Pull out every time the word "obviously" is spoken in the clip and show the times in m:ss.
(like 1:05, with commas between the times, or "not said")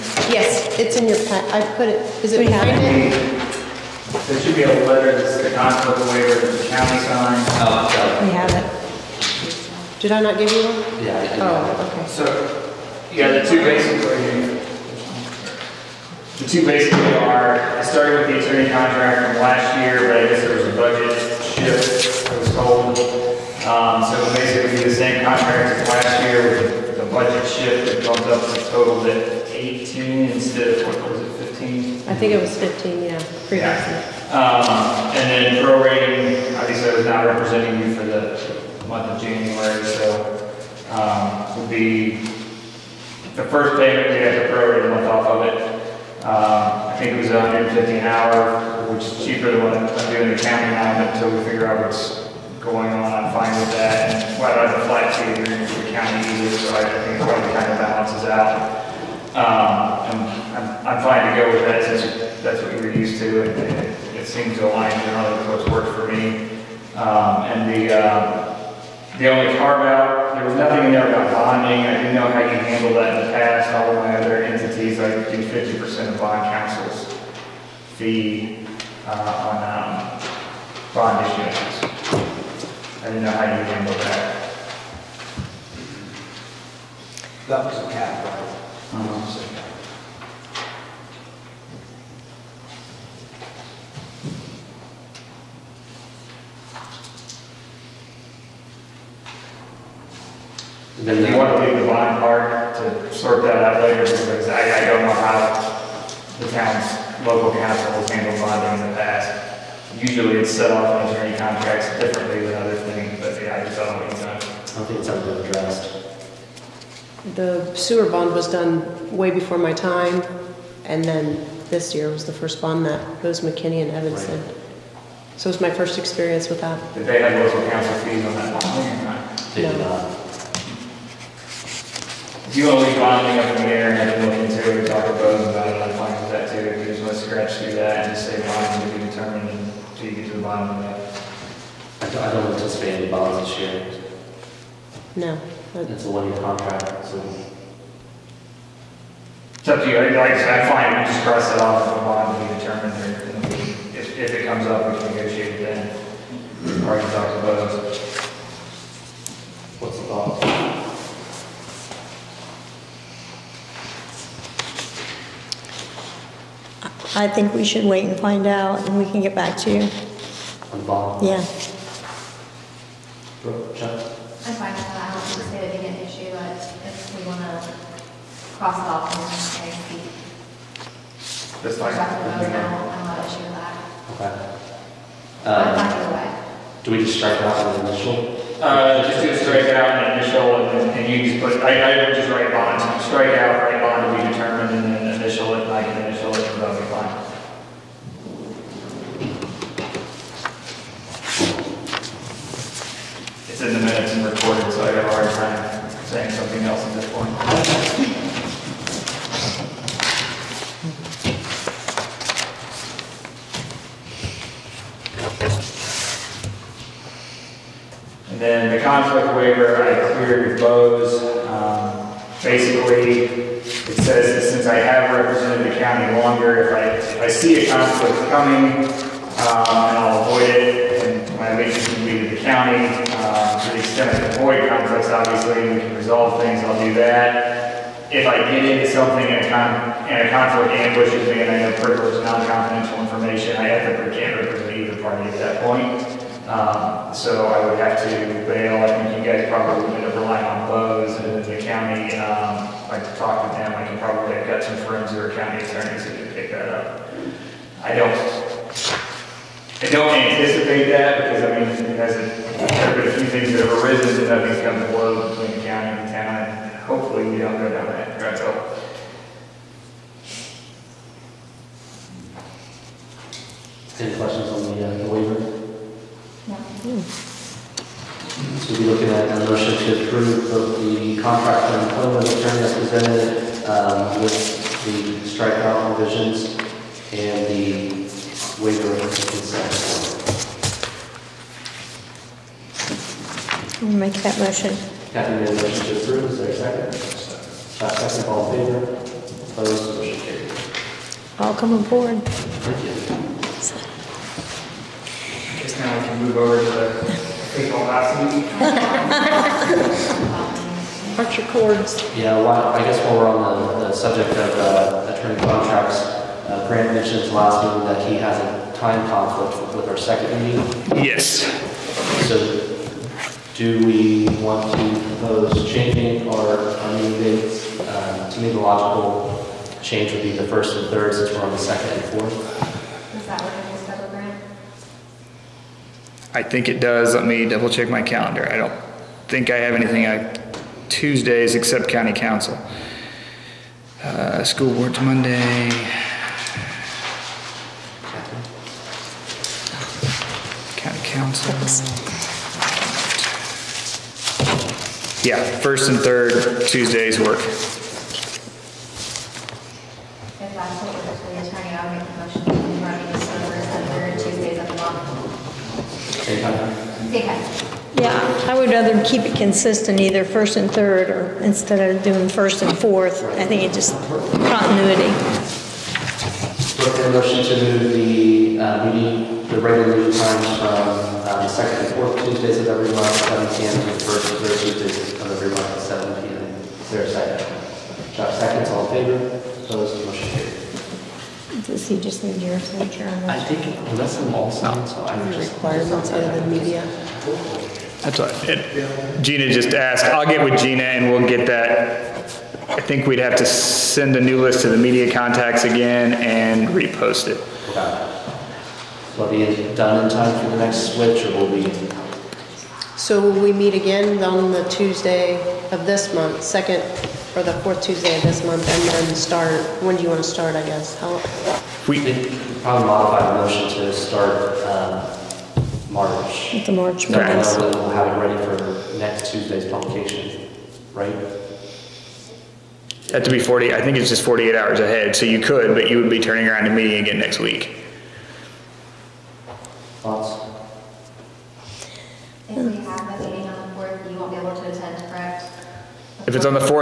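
0:36, 3:55.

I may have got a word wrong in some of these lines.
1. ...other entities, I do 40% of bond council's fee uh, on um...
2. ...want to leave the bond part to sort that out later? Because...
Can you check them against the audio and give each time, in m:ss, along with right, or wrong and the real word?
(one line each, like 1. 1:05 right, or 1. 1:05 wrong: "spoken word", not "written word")
1. 1:14 wrong: "50", not "40"
2. 1:41 right.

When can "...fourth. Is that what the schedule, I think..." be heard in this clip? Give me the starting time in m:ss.
5:32.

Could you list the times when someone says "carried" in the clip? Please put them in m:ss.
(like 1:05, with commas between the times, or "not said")
5:00, 6:30.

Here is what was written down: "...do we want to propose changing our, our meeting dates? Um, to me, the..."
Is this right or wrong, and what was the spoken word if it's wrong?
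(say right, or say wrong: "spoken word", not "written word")
right.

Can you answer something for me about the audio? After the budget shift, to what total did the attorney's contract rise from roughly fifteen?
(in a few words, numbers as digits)
18.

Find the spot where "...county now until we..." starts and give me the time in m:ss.
0:50.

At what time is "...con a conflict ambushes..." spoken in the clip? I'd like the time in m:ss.
3:59.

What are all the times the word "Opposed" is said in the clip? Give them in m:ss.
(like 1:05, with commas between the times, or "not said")
4:59, 6:29.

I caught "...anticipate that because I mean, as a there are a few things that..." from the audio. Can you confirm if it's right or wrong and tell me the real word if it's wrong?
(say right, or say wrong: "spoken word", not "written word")
right.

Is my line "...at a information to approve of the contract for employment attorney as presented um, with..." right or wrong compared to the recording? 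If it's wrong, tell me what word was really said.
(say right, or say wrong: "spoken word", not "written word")
wrong: "motion", not "information".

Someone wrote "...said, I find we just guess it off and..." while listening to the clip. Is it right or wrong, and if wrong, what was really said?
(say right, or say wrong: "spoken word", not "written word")
wrong: "cross", not "guess".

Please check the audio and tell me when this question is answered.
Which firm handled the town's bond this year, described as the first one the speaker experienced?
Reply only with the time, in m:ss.
2:03.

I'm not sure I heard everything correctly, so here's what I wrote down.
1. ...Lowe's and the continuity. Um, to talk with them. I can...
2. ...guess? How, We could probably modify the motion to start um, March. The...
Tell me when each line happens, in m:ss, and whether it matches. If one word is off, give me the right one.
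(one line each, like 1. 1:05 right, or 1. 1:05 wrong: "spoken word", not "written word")
1. 4:10 wrong: "county", not "continuity"
2. 7:00 right.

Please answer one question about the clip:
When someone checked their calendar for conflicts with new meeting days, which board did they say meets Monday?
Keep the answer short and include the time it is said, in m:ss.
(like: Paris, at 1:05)
School board, at 5:44.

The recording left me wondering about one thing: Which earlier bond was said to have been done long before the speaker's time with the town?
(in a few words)
The sewer bond.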